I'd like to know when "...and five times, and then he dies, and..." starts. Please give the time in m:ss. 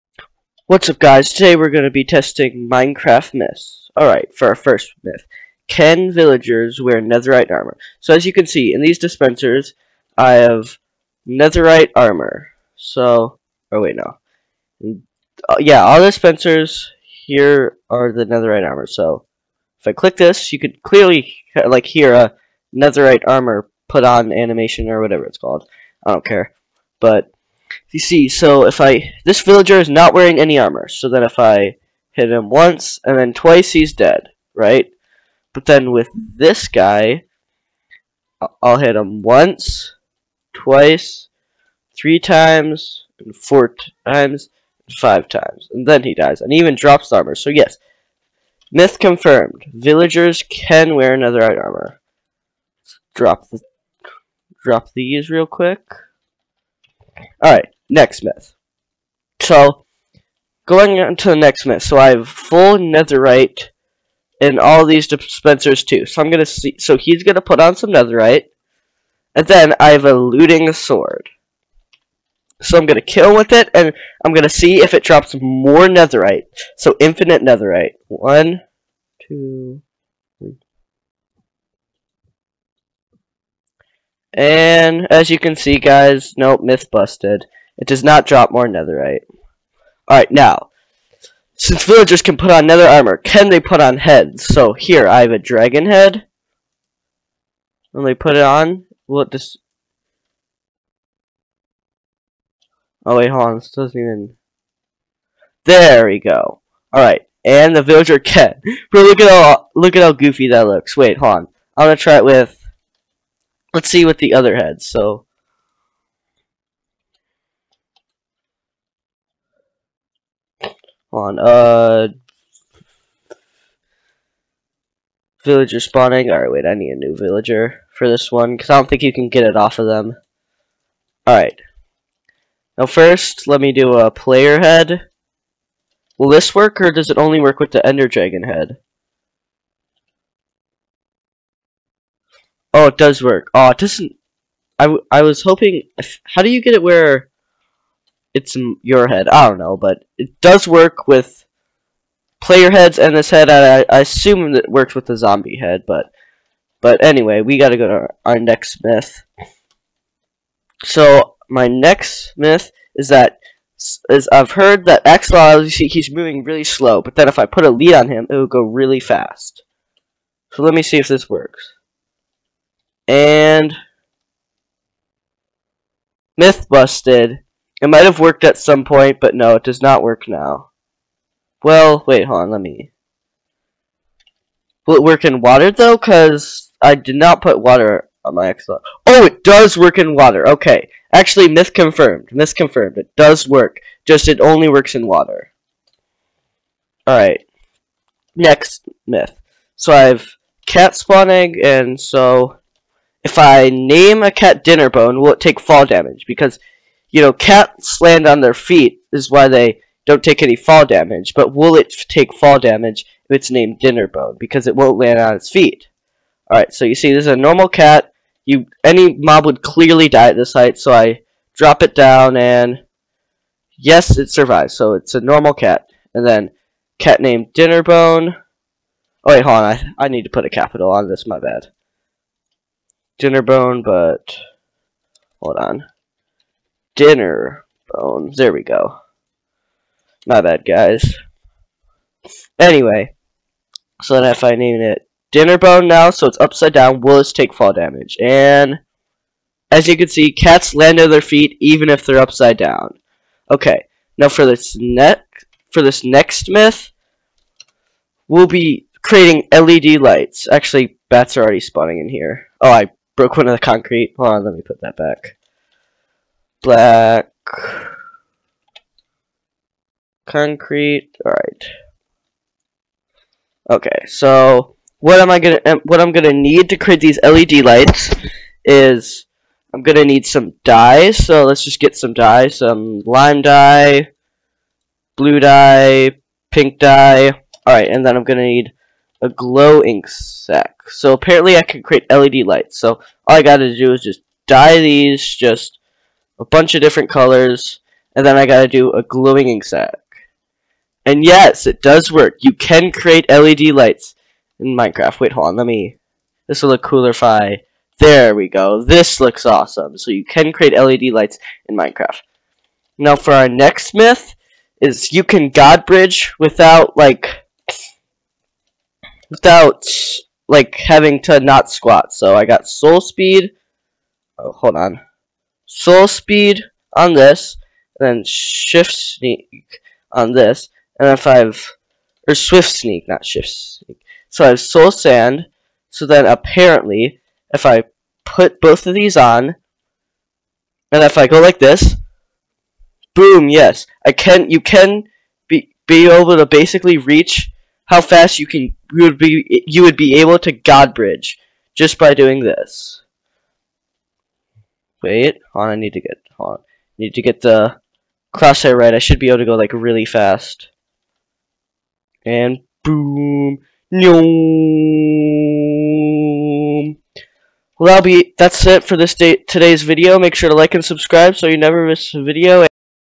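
0:44.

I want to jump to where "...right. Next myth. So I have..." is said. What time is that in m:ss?
3:17.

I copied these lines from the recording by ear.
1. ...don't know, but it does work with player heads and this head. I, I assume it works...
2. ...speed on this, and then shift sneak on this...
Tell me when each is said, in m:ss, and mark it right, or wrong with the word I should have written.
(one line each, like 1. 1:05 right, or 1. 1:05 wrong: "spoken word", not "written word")
1. 2:29 right
2. 5:26 right.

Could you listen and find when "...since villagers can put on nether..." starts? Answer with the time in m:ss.
1:31.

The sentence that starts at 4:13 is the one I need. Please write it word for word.
Okay, now for this for this next myth, we'll be creating LED lights.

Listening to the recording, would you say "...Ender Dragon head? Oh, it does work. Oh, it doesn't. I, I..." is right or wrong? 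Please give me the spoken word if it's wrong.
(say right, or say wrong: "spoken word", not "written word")
right.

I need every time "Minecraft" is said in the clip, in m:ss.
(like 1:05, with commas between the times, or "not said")
0:02, 5:04, 5:11.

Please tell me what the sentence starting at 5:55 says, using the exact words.
Wait, on I need to get on need to get the crosshair right.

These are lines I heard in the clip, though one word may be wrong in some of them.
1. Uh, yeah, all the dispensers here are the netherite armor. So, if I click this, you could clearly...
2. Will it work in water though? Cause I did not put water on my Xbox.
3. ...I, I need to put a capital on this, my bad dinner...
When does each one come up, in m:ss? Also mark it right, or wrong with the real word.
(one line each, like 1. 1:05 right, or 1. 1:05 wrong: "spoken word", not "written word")
1. 0:15 right
2. 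3:04 right
3. 3:49 right.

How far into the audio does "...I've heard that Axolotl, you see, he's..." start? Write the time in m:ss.
2:44.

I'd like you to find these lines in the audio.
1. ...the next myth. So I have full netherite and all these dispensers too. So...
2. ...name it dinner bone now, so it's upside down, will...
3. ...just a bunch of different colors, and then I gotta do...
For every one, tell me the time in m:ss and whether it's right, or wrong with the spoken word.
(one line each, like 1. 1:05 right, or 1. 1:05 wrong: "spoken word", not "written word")
1. 1:01 right
2. 4:04 right
3. 4:55 right.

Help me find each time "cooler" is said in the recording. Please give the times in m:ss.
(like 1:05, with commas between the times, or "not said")
5:06.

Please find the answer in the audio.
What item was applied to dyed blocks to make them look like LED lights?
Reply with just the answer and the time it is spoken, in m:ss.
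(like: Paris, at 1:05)
Glow ink sac, at 4:49.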